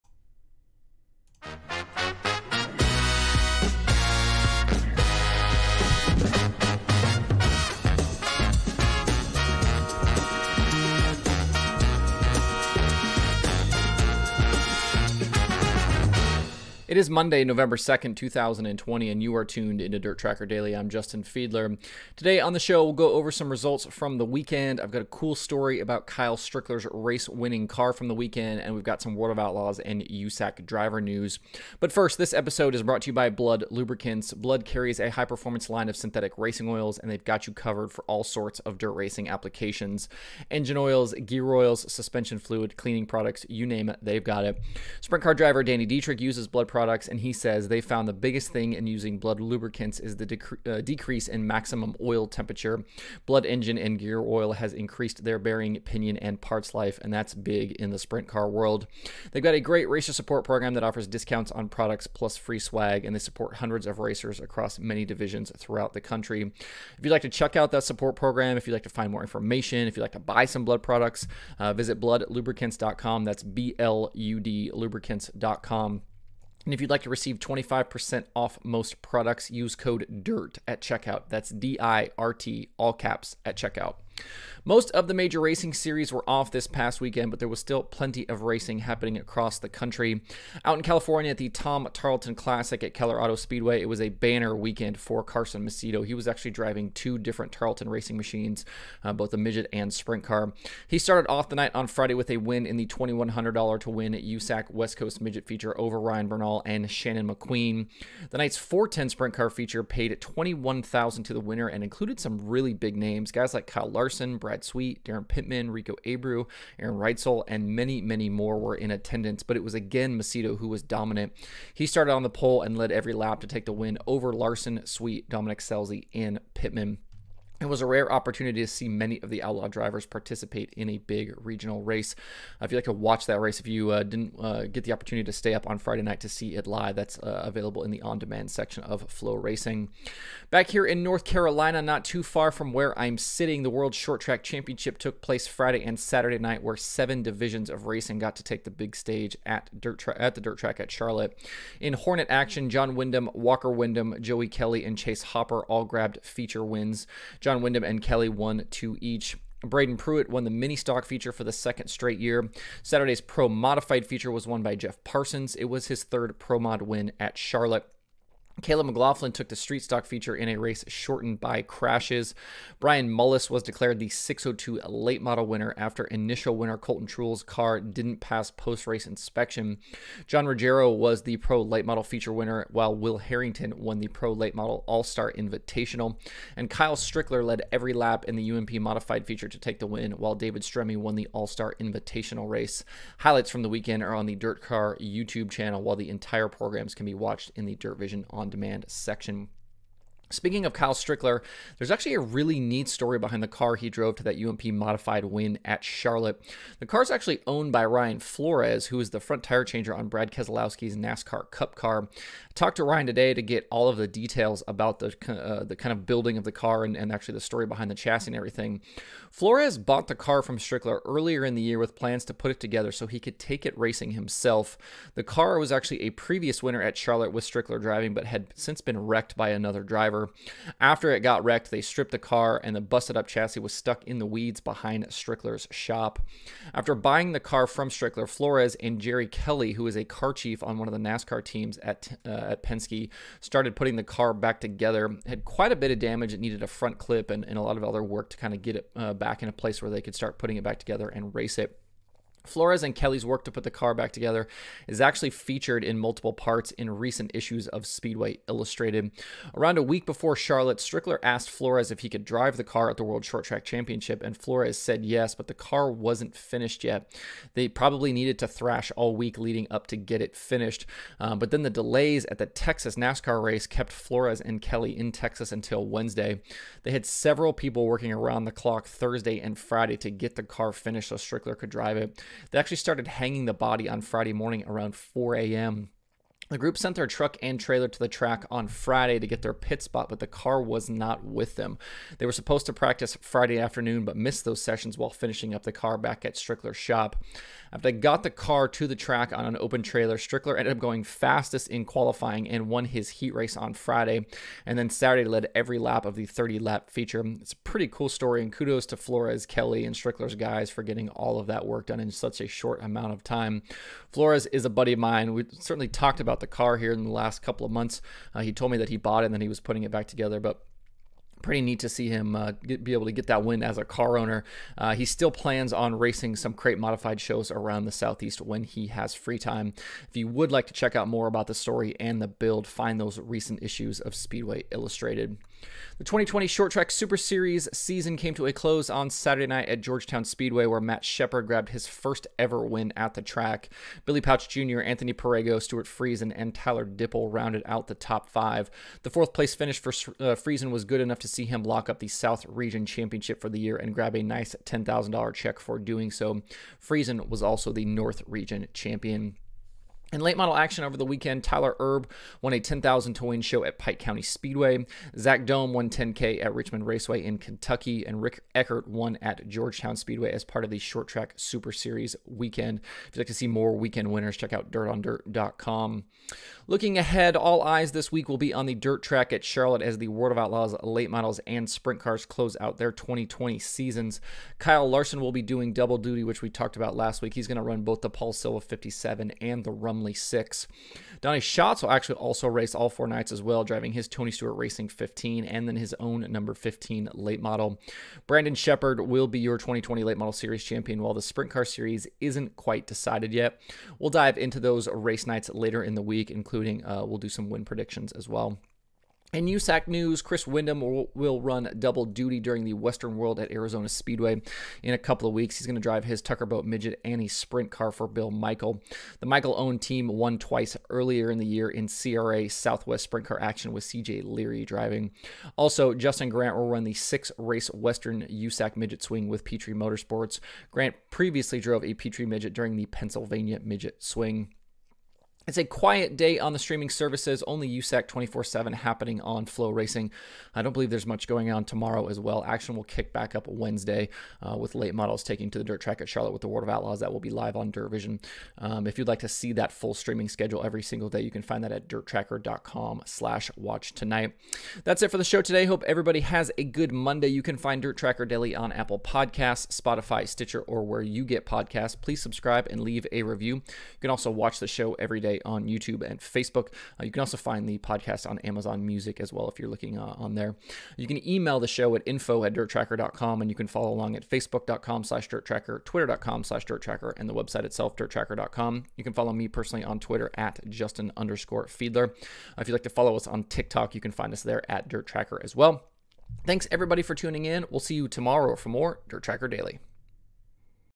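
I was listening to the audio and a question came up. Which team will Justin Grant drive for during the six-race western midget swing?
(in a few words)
Petrie Motorsports.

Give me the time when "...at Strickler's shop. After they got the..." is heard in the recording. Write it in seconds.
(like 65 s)
296 s.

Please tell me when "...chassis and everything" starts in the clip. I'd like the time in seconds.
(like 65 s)
217 s.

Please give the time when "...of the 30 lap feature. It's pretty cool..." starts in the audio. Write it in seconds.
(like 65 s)
306 s.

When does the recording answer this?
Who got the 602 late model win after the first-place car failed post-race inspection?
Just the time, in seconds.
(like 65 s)
172 s.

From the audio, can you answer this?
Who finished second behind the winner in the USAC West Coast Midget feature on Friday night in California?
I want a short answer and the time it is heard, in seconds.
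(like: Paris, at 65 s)
Ryan Bernal, at 105 s.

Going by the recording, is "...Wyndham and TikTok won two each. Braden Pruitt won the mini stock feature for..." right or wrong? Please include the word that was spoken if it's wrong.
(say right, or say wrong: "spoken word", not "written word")
wrong: "Kelly", not "TikTok".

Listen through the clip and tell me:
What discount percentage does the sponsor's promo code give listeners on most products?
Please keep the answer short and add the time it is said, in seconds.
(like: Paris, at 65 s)
25%, at 77 s.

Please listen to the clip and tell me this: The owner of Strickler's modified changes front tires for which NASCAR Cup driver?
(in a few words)
Brad Keselowski.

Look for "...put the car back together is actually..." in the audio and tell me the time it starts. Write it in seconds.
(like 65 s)
253 s.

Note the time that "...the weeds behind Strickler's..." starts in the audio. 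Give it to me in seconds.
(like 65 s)
234 s.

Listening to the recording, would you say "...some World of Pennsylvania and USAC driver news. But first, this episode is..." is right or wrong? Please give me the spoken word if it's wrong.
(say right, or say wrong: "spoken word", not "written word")
wrong: "Outlaws", not "Pennsylvania".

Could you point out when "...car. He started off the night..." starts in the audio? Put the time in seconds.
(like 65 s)
100 s.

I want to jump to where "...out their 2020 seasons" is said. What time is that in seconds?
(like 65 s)
382 s.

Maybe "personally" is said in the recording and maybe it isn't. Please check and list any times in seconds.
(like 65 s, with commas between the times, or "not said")
479 s.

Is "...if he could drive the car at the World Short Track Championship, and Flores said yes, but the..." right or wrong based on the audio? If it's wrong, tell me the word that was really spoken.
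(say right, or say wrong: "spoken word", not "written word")
right.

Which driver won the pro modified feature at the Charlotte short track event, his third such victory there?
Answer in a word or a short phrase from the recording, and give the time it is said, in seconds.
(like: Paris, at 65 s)
Jeff Parsons, at 164 s.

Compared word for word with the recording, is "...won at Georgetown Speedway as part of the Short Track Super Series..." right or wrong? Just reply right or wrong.
right.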